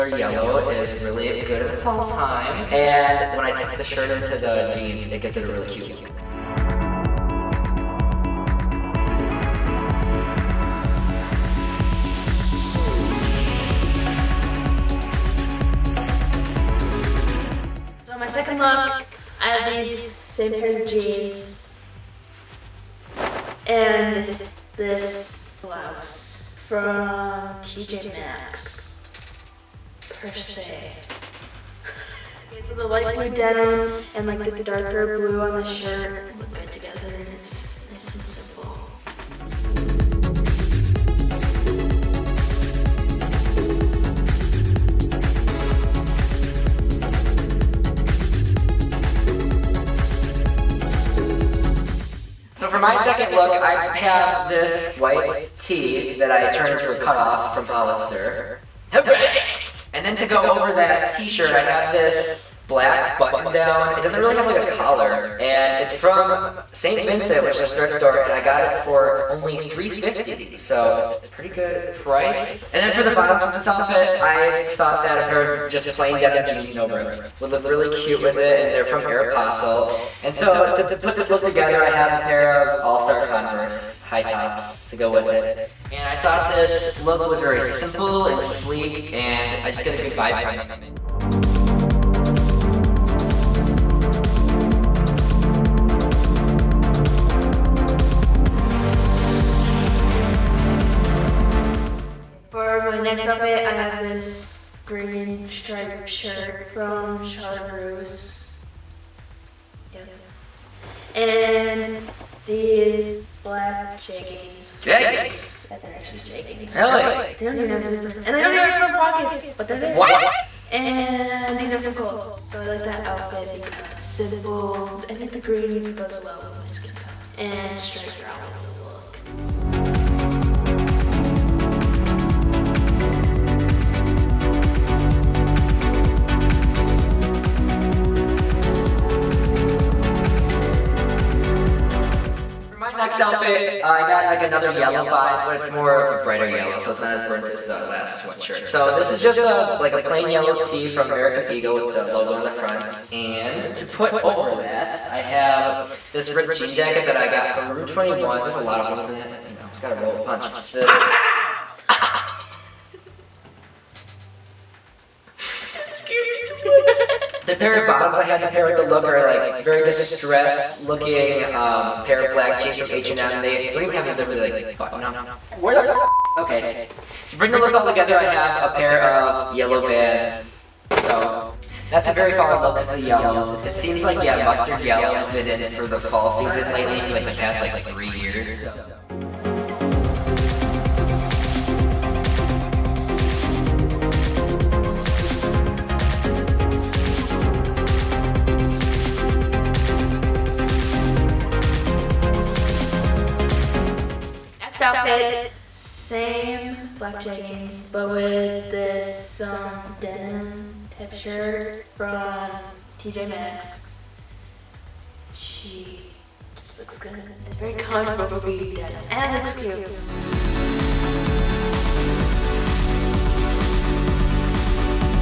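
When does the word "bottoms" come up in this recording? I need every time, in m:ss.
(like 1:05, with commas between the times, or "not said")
1:13, 2:47.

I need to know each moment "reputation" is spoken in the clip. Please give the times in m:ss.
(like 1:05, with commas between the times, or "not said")
not said.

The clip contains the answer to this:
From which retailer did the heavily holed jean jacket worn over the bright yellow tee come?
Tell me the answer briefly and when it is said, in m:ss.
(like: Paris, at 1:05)
Rue 21, at 2:37.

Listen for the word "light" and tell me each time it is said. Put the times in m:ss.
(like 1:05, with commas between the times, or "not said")
0:32.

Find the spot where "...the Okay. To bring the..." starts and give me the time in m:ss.
2:55.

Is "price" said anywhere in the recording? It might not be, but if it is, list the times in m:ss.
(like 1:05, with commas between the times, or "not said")
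1:11.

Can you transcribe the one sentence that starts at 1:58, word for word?
And they don't even have front pockets, but they're there.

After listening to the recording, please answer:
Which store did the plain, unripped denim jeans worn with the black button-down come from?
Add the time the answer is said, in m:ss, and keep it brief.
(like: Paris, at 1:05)
Aeropostale, at 1:19.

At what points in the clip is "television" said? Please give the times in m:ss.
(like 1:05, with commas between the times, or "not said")
not said.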